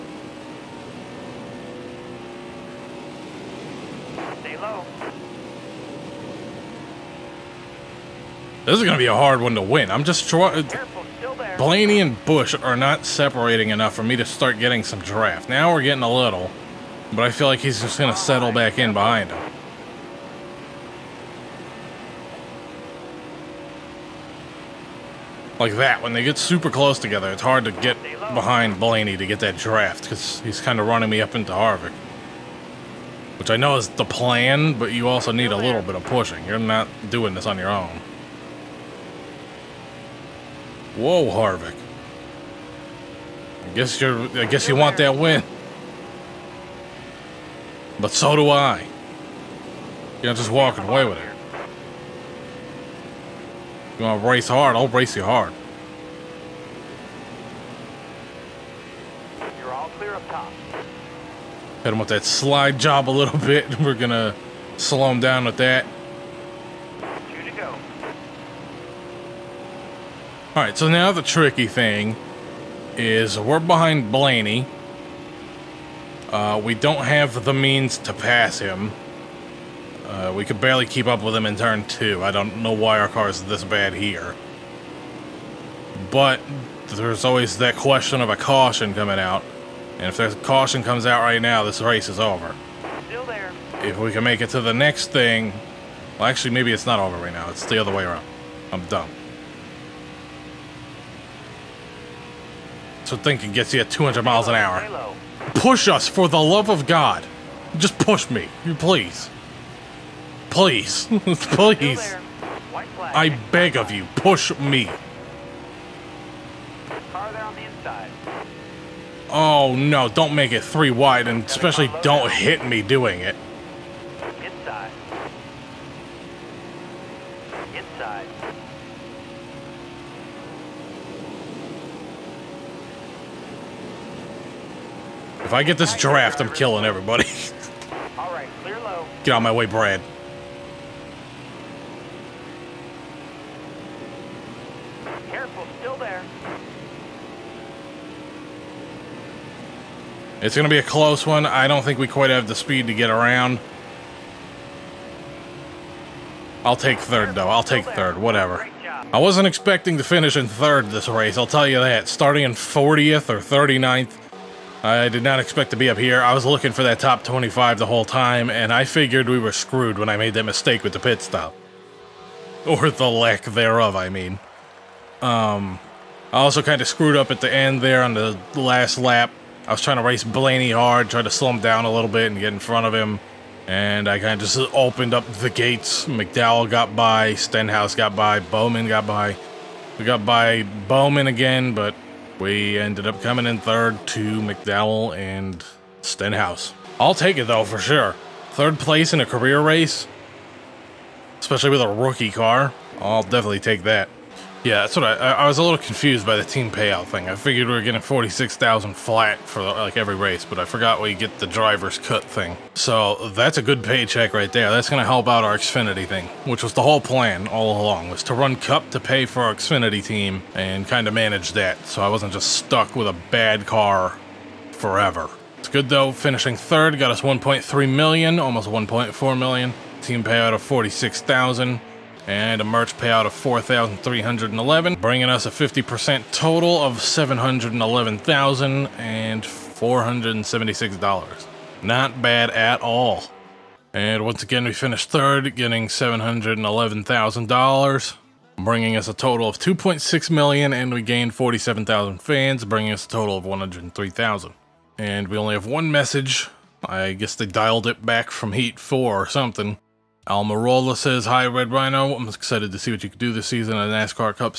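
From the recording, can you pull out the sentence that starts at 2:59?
I was trying to race Blaney hard, tried to slow him down a little bit and get in front of him.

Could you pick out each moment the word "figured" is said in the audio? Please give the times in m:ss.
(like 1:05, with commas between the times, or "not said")
2:48, 3:27.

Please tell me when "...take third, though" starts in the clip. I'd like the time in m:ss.
2:36.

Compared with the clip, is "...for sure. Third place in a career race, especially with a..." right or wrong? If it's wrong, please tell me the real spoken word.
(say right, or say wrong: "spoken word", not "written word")
right.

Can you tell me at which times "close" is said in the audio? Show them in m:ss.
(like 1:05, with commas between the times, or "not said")
0:26, 2:30.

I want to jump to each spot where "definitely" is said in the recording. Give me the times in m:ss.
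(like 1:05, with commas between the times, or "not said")
3:23.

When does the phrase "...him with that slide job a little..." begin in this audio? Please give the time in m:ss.
1:01.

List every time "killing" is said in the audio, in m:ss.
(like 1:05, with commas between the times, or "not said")
2:16.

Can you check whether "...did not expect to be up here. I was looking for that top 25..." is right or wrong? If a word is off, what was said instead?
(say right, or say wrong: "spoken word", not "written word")
right.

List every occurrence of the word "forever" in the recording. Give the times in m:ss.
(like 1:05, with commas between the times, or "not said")
3:44.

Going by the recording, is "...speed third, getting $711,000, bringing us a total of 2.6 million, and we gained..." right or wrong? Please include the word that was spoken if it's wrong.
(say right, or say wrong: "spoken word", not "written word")
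wrong: "finished", not "speed".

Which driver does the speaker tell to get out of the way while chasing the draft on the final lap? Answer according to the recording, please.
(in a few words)
Brad.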